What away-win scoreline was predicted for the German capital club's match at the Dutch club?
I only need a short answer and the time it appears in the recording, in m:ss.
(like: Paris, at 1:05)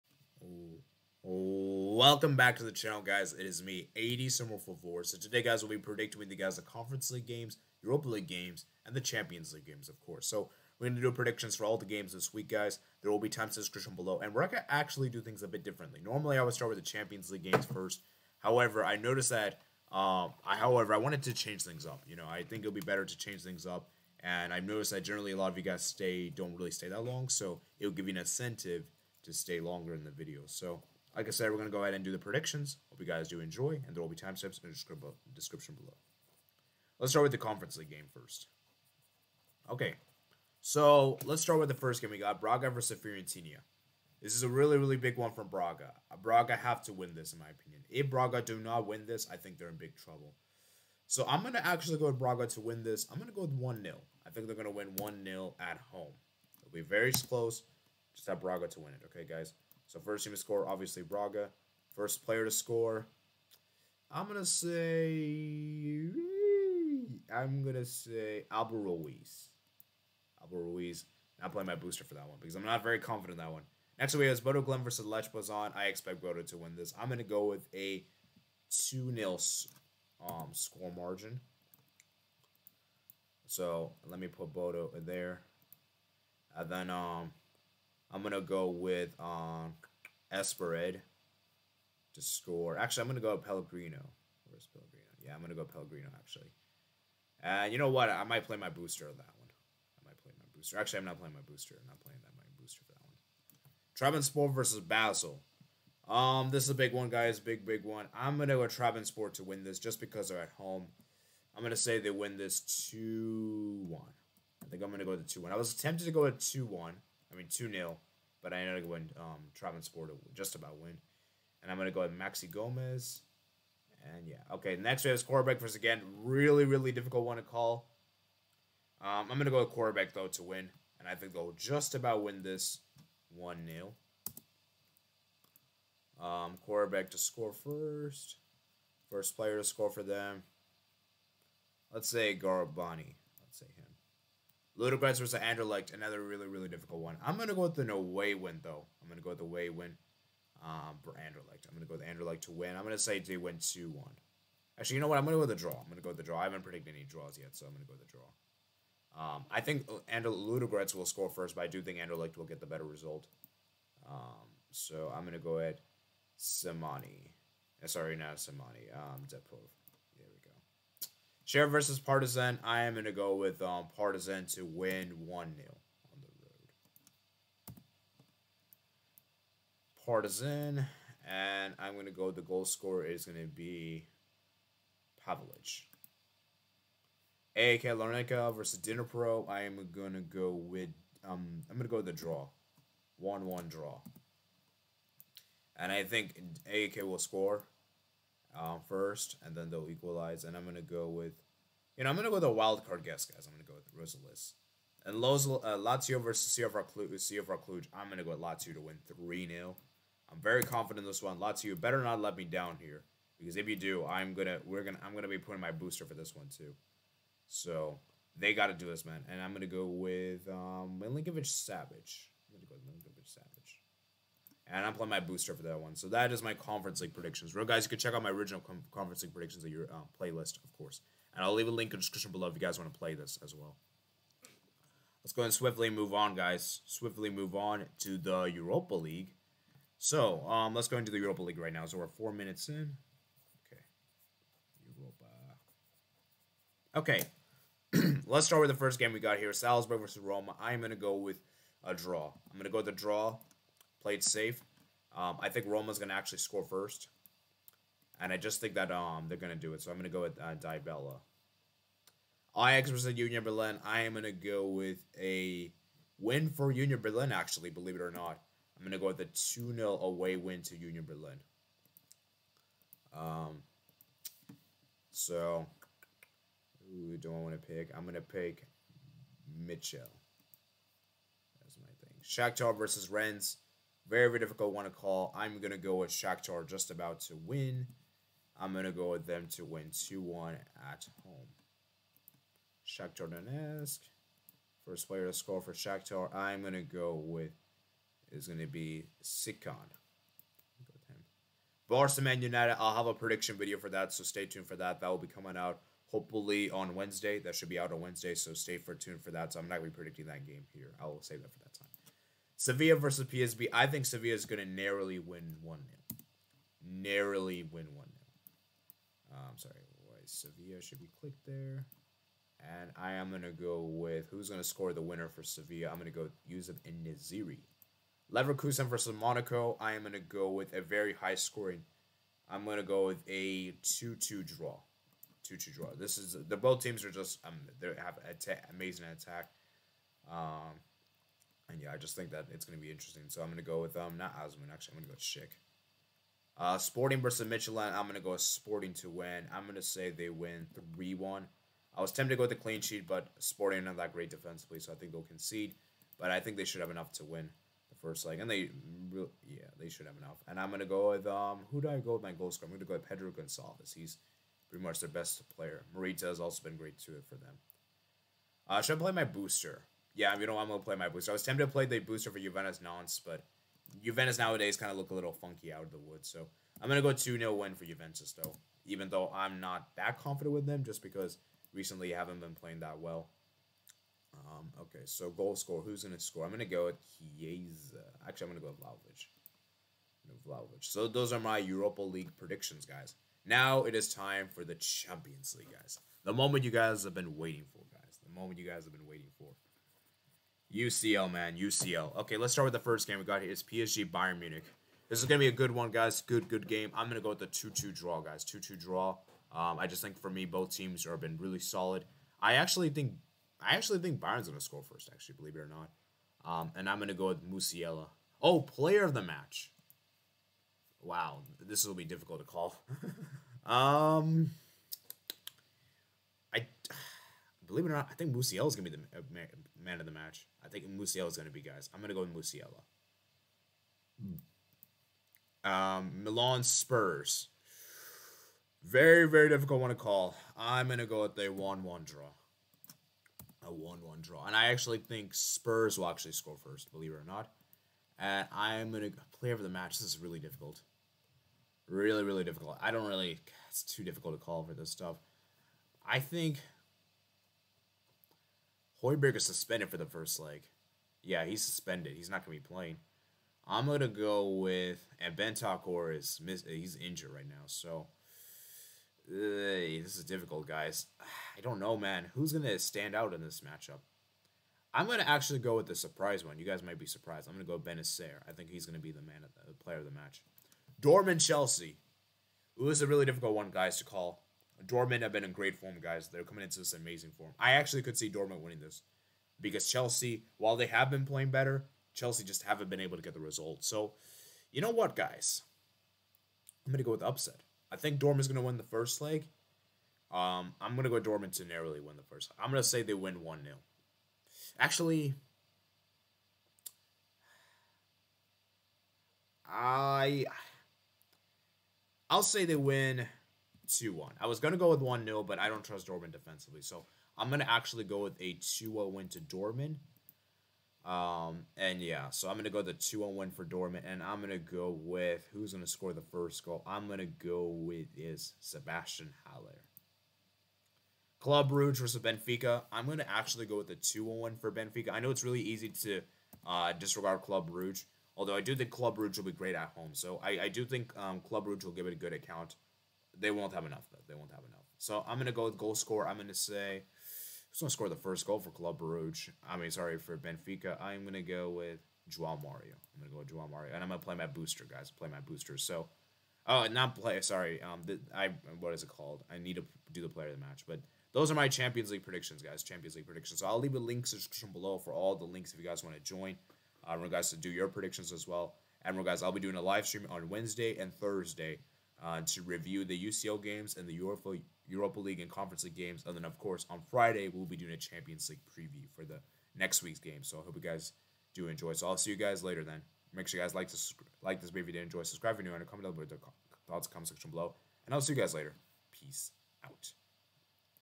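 2-0, at 4:29.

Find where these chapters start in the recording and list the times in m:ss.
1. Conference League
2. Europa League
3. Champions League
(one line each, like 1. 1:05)
1. 0:30
2. 4:00
3. 6:36.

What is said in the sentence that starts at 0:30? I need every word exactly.
So like I said, we're going to go ahead and do the predictions.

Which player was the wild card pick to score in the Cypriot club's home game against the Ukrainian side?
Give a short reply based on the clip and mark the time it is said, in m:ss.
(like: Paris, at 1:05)
Rosales, at 3:23.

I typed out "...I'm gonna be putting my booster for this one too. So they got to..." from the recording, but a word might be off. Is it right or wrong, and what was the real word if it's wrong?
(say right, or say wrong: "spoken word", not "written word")
right.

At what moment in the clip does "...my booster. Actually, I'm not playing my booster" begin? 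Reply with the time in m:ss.
1:40.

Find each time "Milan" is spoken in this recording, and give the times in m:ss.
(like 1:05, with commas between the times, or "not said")
7:16.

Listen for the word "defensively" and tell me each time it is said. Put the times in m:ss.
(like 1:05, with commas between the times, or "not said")
5:54, 8:36.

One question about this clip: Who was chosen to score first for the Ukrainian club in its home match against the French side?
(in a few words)
Sikan.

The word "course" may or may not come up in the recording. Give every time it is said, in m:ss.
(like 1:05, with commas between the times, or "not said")
0:10, 3:50, 9:36.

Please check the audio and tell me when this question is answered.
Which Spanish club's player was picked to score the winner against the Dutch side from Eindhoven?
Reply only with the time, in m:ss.
5:26.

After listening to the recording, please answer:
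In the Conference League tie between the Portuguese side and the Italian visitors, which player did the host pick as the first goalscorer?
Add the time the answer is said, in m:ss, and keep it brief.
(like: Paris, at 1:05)
Abel Ruiz, at 1:08.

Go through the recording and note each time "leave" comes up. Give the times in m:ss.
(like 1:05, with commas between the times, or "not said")
3:51, 9:23.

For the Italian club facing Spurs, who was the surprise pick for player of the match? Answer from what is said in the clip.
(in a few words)
Bennacer.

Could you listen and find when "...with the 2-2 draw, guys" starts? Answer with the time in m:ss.
6:47.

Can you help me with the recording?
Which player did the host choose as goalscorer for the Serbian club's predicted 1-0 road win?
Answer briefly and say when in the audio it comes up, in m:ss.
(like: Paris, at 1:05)
Pavlich, at 3:05.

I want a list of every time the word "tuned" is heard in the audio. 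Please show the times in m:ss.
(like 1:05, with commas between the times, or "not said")
5:04, 5:08.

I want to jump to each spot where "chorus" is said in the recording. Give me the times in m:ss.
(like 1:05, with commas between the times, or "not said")
not said.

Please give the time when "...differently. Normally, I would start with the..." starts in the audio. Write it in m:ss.
0:15.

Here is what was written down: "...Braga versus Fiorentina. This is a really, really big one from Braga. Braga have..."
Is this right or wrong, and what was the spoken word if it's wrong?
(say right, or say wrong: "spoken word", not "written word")
right.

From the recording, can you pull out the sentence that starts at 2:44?
Um, so I'm going to go at Simoni.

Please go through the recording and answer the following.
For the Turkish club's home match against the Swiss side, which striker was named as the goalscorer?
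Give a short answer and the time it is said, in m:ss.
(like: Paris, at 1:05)
Maxi Gomez, at 2:02.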